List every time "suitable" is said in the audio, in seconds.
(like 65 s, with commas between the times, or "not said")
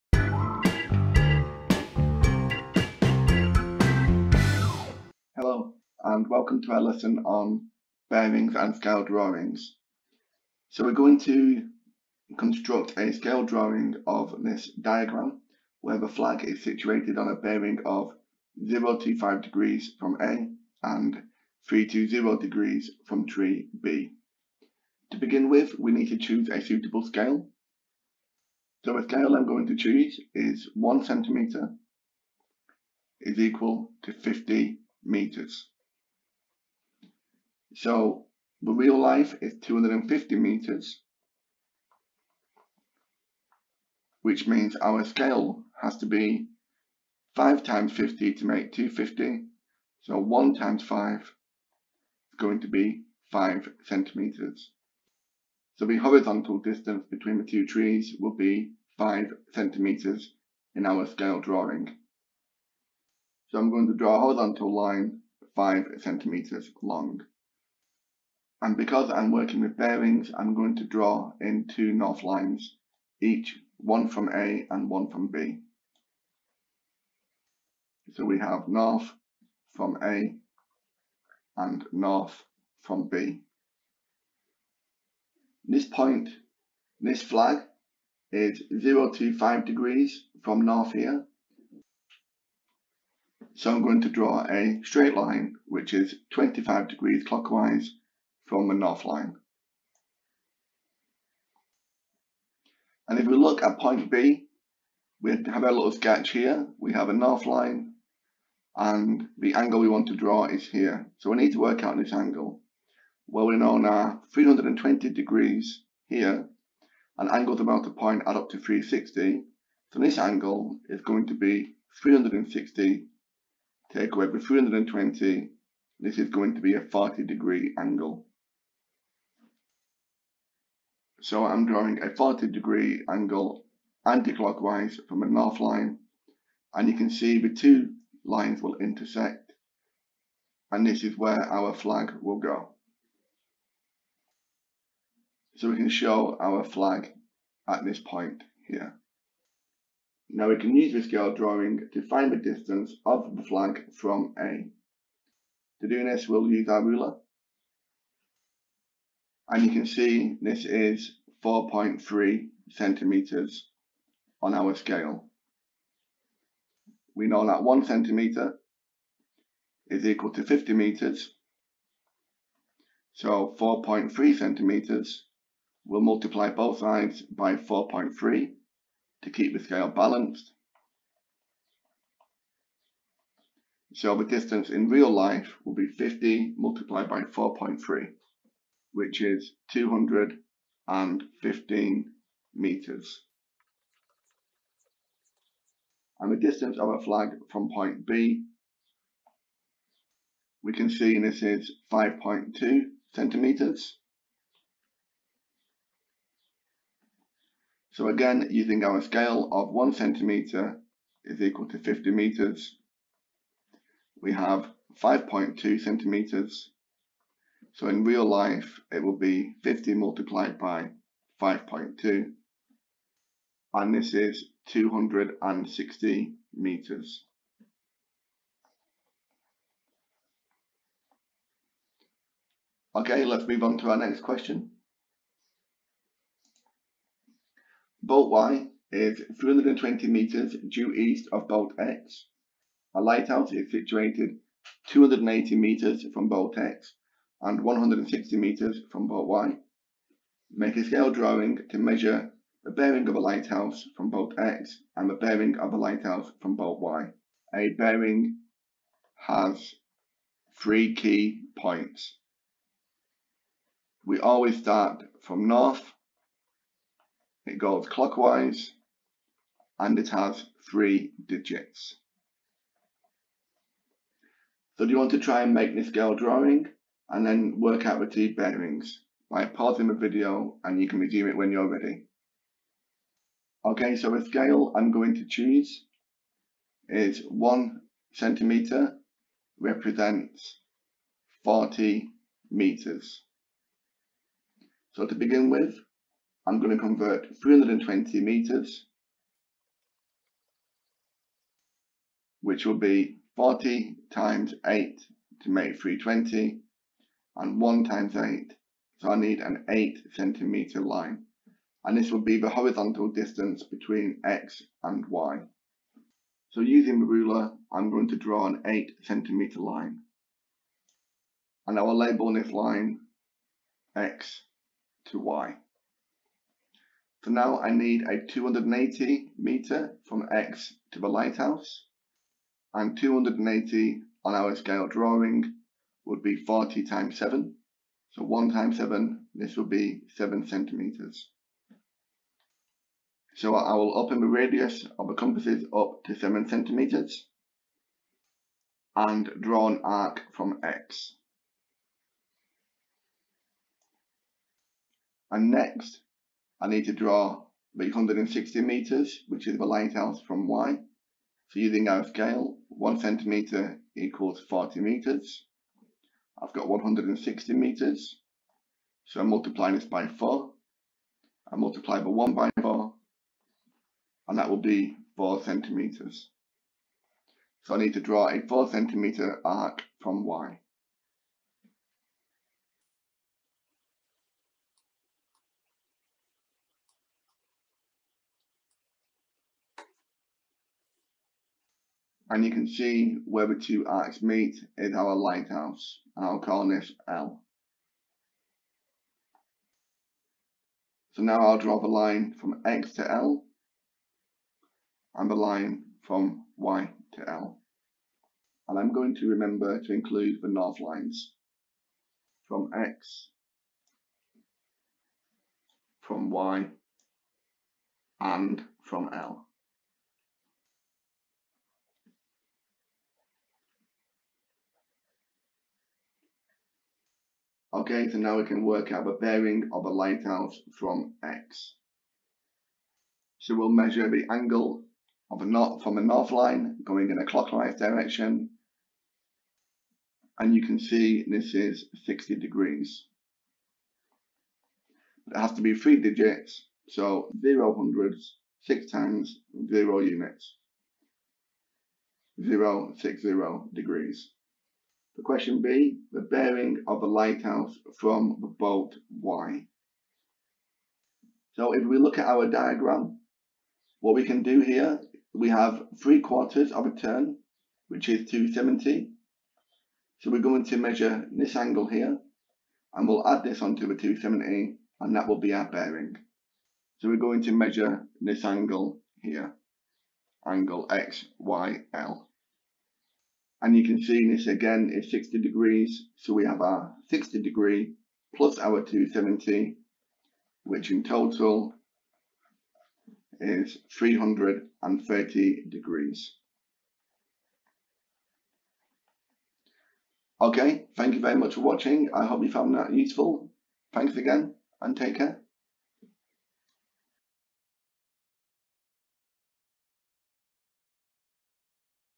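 26 s.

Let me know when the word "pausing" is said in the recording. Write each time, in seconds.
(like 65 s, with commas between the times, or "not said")
279 s.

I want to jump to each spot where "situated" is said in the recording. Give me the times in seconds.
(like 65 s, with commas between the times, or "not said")
16 s, 243 s.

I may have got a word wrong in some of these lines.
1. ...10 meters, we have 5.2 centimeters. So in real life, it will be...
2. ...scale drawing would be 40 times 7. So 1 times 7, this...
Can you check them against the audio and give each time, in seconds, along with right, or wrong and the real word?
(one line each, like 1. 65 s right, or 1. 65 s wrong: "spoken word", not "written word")
1. 211 s wrong: "50", not "10"
2. 334 s right.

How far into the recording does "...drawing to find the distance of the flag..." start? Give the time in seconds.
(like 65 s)
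151 s.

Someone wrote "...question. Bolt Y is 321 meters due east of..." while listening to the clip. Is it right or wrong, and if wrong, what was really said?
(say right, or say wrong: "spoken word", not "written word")
wrong: "320", not "321".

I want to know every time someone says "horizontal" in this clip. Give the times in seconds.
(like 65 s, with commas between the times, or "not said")
55 s, 64 s, 312 s.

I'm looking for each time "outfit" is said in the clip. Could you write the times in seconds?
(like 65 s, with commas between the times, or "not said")
not said.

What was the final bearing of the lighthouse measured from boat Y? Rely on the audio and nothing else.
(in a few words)
330 degrees.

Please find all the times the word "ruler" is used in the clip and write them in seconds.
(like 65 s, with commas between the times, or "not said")
156 s, 317 s.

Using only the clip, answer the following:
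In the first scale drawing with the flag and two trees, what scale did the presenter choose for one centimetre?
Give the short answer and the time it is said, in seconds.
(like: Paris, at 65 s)
50 meters, at 30 s.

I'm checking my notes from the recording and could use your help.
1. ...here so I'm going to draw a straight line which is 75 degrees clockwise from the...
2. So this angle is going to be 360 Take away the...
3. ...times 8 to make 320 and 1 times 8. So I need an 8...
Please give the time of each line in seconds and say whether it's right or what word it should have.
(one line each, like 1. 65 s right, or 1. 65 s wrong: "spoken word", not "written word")
1. 90 s wrong: "25", not "75"
2. 119 s right
3. 304 s right.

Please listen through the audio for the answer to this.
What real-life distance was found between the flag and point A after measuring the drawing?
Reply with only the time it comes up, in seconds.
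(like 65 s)
189 s.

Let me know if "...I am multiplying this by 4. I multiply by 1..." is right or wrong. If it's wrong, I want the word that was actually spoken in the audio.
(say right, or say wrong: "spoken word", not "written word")
right.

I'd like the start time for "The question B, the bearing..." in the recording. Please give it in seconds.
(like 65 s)
455 s.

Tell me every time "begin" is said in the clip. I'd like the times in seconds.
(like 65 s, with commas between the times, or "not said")
25 s, 295 s.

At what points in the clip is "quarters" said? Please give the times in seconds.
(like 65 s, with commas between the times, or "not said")
466 s.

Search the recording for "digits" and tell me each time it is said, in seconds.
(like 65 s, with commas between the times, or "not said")
271 s, 446 s.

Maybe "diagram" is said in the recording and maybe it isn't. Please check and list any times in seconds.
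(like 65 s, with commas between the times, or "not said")
14 s, 462 s.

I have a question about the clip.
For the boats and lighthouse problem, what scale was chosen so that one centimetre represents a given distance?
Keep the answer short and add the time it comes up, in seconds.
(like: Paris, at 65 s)
40 meters, at 287 s.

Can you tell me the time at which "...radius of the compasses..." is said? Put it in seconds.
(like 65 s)
344 s.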